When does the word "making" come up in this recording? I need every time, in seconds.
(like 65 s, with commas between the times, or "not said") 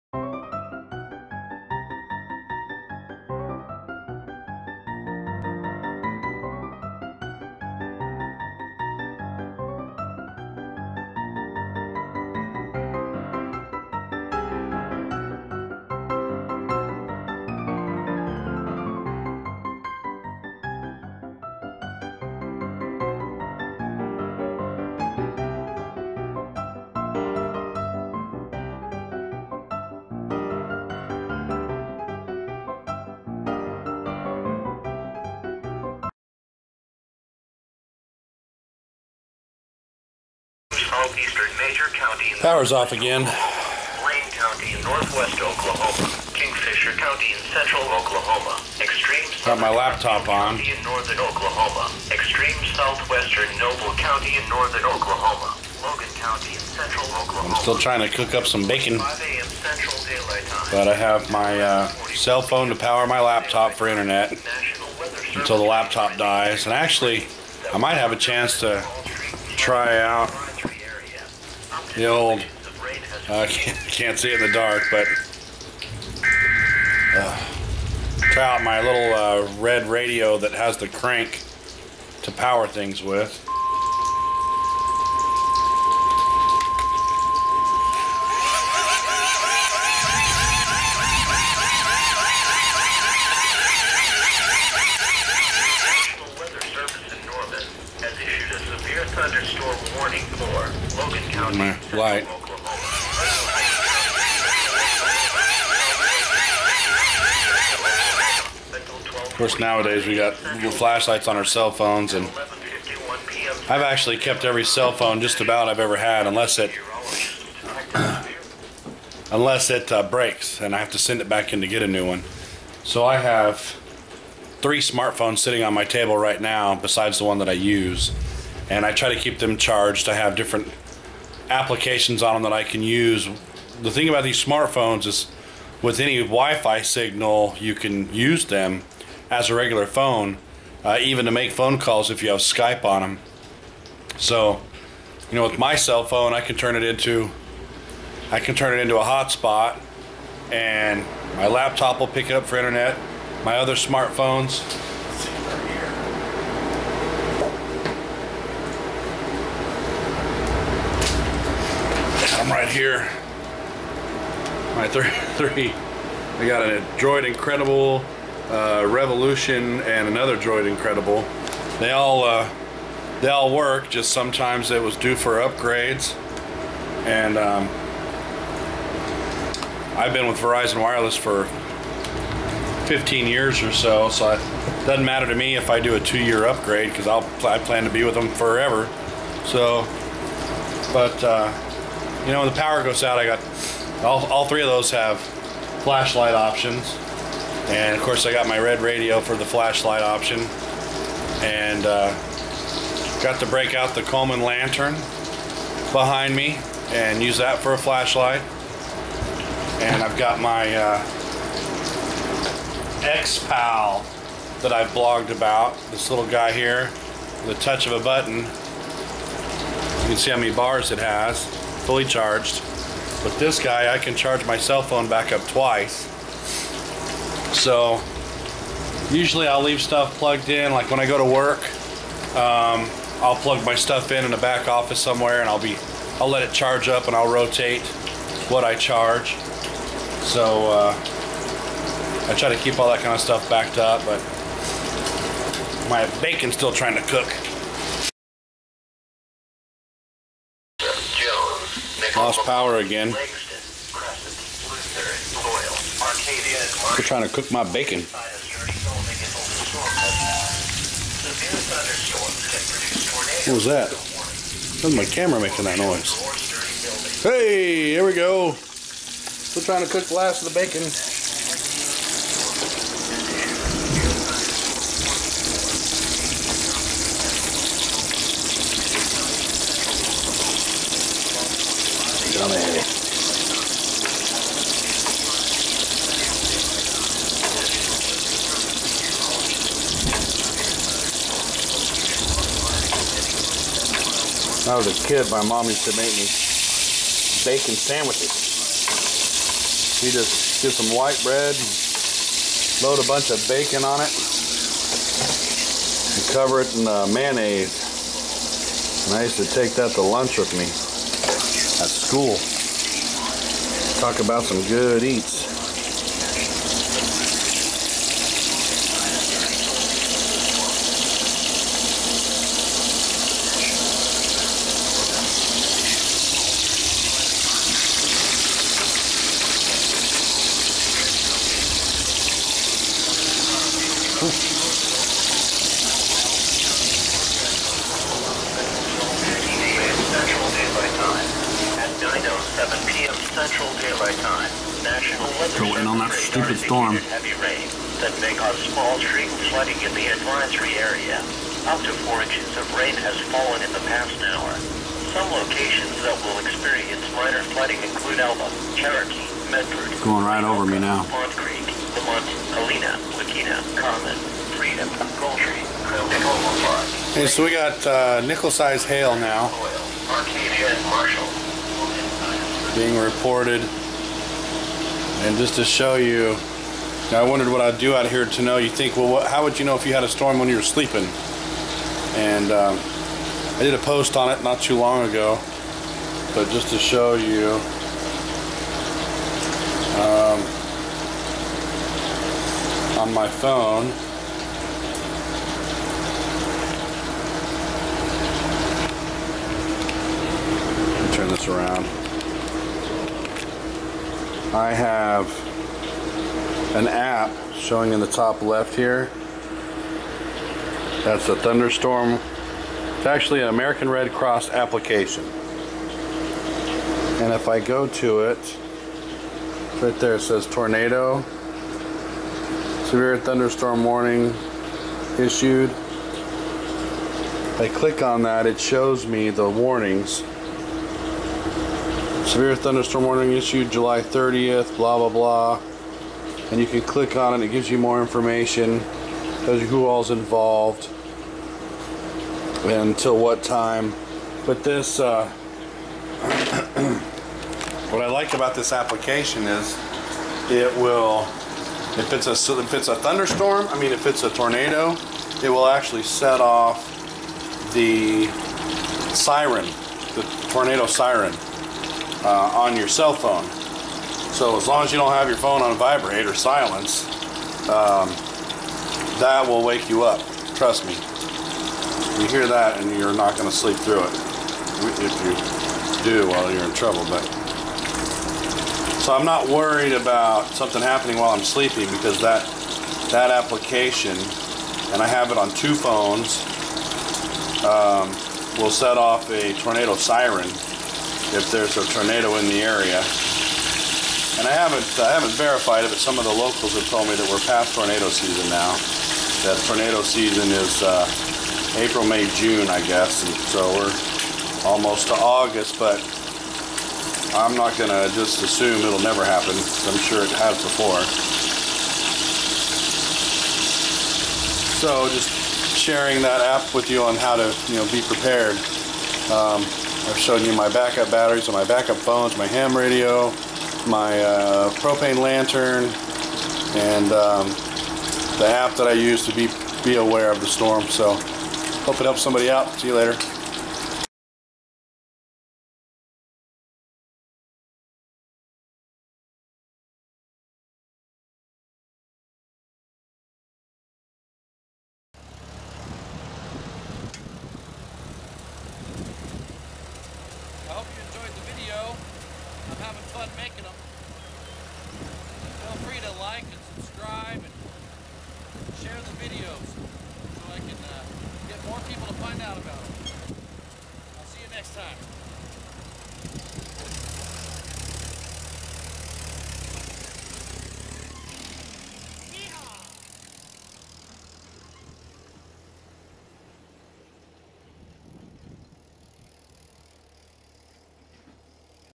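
265 s.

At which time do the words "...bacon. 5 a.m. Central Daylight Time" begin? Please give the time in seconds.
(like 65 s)
58 s.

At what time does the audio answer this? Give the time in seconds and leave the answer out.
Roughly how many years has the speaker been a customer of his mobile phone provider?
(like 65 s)
182 s.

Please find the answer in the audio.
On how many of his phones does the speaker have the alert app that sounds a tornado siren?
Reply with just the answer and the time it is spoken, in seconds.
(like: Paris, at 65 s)
2, at 485 s.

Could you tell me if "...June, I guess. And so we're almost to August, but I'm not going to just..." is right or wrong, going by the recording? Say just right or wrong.
right.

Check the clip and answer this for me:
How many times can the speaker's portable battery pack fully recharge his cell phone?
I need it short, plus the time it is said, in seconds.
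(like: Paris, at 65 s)
Twice, at 225 s.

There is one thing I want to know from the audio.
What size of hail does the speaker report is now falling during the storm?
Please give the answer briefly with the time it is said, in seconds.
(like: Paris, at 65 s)
Nickel-sized, at 368 s.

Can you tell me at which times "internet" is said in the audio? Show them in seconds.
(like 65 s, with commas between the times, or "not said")
63 s, 152 s.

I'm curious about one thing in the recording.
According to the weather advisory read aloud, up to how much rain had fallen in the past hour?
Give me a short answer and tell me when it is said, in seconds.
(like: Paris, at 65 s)
4 inches, at 352 s.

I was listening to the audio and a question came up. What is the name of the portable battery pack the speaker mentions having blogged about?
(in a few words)
X-Pal.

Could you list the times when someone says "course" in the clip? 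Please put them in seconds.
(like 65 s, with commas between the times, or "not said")
109 s, 198 s.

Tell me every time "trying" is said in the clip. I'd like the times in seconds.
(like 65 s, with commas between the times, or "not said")
57 s, 246 s, 257 s, 269 s.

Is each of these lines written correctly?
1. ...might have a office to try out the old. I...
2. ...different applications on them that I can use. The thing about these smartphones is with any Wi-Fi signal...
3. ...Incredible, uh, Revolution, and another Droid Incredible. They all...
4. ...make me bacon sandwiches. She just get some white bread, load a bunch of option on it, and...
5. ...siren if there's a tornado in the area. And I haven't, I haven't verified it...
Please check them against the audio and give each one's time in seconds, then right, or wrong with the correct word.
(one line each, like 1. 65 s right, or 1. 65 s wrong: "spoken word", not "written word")
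1. 67 s wrong: "chance", not "office"
2. 130 s right
3. 167 s right
4. 295 s wrong: "bacon", not "option"
5. 489 s right.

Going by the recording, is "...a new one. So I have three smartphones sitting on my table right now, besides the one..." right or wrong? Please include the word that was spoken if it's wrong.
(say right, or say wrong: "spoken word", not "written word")
right.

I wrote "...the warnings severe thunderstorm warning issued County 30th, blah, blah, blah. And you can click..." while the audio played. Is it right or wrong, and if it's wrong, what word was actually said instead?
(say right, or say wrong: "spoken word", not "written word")
wrong: "July", not "County".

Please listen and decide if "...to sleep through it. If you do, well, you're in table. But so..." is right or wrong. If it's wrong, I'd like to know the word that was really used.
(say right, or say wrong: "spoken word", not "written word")
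wrong: "trouble", not "table".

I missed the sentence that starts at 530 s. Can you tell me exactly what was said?
So hope it helps somebody out.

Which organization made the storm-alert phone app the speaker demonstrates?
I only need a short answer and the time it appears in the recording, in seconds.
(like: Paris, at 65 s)
American Red Cross, at 413 s.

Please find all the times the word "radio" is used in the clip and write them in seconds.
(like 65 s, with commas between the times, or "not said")
79 s, 198 s, 522 s.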